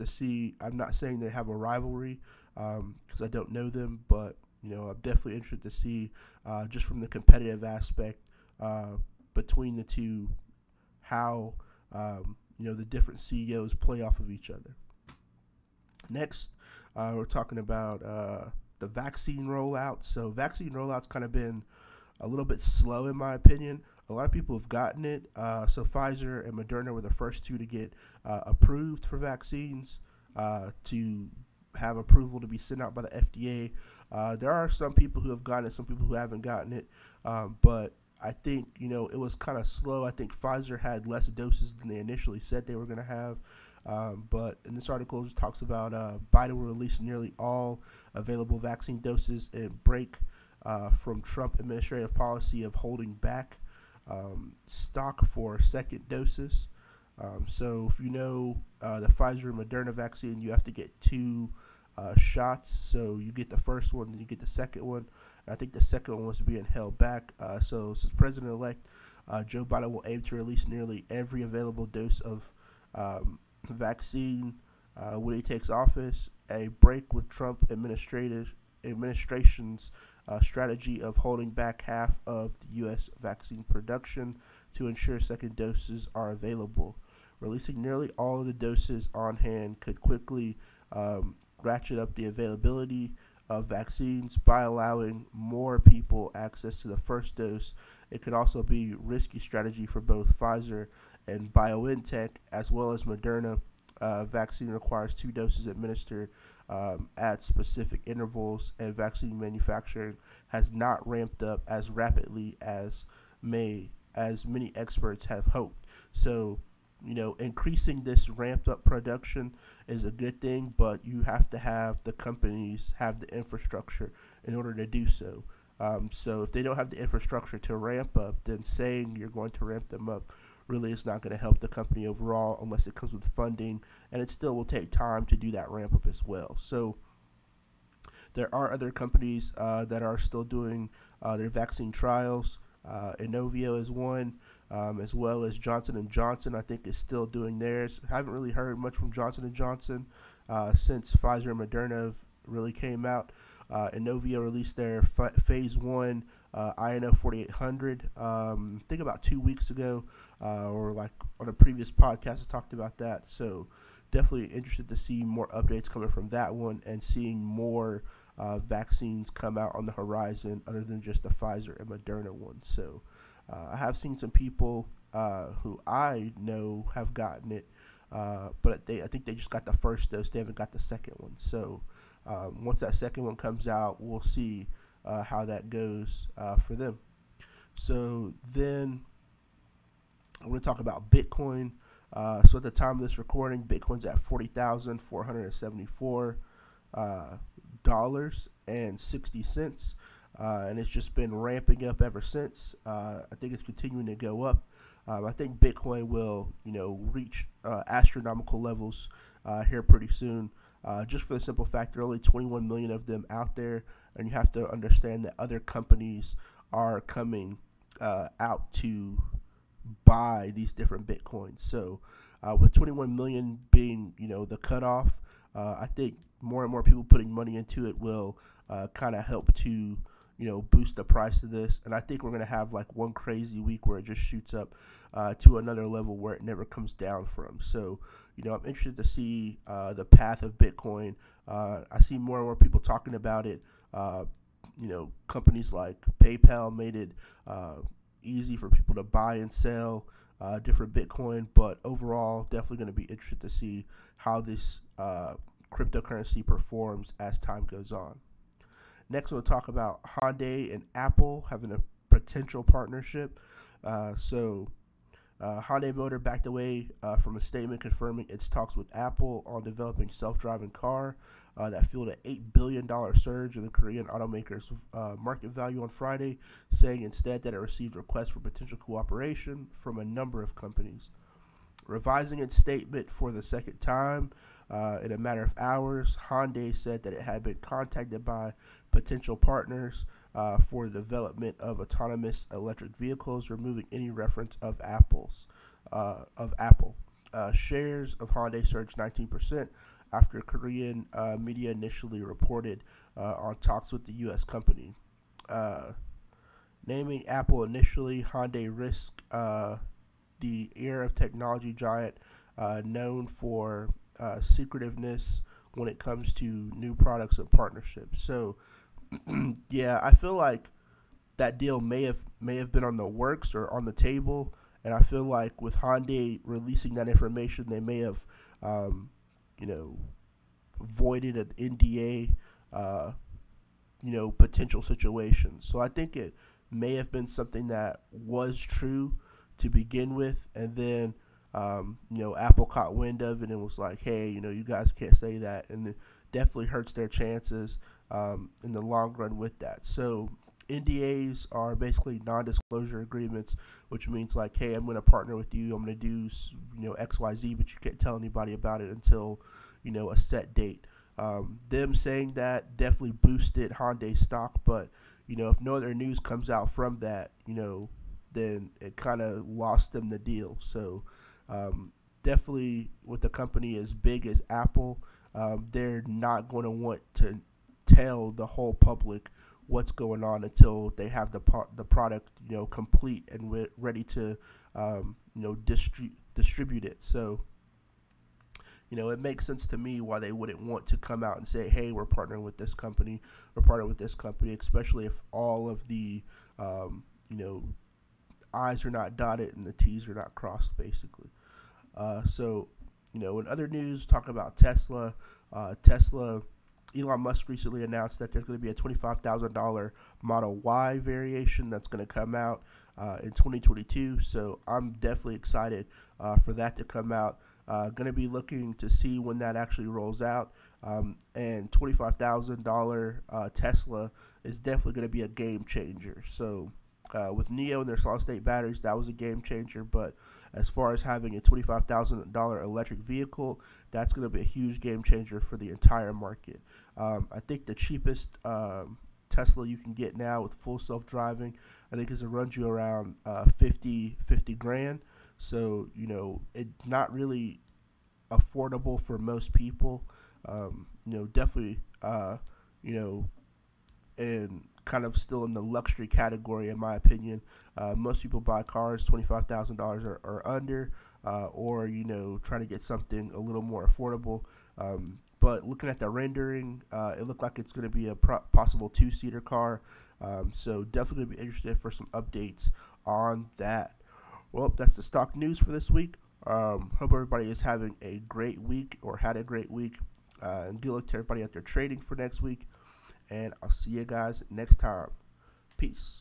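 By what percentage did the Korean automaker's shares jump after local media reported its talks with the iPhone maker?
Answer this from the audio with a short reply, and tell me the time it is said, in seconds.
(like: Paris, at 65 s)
19%, at 298 s.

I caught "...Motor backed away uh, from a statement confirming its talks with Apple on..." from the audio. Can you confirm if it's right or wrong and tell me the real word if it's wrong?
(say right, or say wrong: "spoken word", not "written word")
right.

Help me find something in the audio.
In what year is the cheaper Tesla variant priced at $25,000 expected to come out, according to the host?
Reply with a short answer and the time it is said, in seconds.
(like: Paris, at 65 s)
2022, at 413 s.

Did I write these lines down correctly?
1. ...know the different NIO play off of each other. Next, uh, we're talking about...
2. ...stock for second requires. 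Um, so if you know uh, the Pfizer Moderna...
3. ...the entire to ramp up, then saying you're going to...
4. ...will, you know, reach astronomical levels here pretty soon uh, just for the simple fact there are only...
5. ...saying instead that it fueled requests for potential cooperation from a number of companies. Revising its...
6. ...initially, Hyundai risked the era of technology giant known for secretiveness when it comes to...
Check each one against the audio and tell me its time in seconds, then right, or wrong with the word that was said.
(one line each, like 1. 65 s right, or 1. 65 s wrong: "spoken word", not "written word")
1. 12 s wrong: "CEOs", not "NIO"
2. 54 s wrong: "doses", not "requires"
3. 126 s wrong: "infrastructure", not "entire"
4. 206 s right
5. 276 s wrong: "received", not "fueled"
6. 307 s right.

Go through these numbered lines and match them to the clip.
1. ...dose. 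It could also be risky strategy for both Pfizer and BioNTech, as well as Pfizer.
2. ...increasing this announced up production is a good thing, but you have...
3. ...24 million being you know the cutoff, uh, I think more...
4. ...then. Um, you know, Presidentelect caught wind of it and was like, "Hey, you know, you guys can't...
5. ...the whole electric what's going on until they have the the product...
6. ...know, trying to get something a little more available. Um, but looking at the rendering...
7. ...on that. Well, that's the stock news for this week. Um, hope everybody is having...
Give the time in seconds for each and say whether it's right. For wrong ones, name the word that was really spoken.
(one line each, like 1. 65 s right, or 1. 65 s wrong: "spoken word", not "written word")
1. 97 s wrong: "Moderna", not "Pfizer"
2. 117 s wrong: "ramped", not "announced"
3. 222 s wrong: "21", not "24"
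4. 340 s wrong: "Apple", not "Presidentelect"
5. 378 s wrong: "public", not "electric"
6. 462 s wrong: "affordable", not "available"
7. 473 s right.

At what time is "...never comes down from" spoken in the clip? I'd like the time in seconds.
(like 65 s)
236 s.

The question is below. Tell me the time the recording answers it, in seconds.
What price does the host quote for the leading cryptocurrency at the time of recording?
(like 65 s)
194 s.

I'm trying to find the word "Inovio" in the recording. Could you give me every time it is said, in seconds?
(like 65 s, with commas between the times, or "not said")
143 s, 153 s.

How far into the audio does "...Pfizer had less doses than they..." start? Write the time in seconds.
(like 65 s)
40 s.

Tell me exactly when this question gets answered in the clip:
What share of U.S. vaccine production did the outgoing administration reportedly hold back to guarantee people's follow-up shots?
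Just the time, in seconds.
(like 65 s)
81 s.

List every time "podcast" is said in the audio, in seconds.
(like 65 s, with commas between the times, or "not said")
161 s.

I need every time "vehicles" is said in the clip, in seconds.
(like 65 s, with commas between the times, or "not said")
292 s, 432 s.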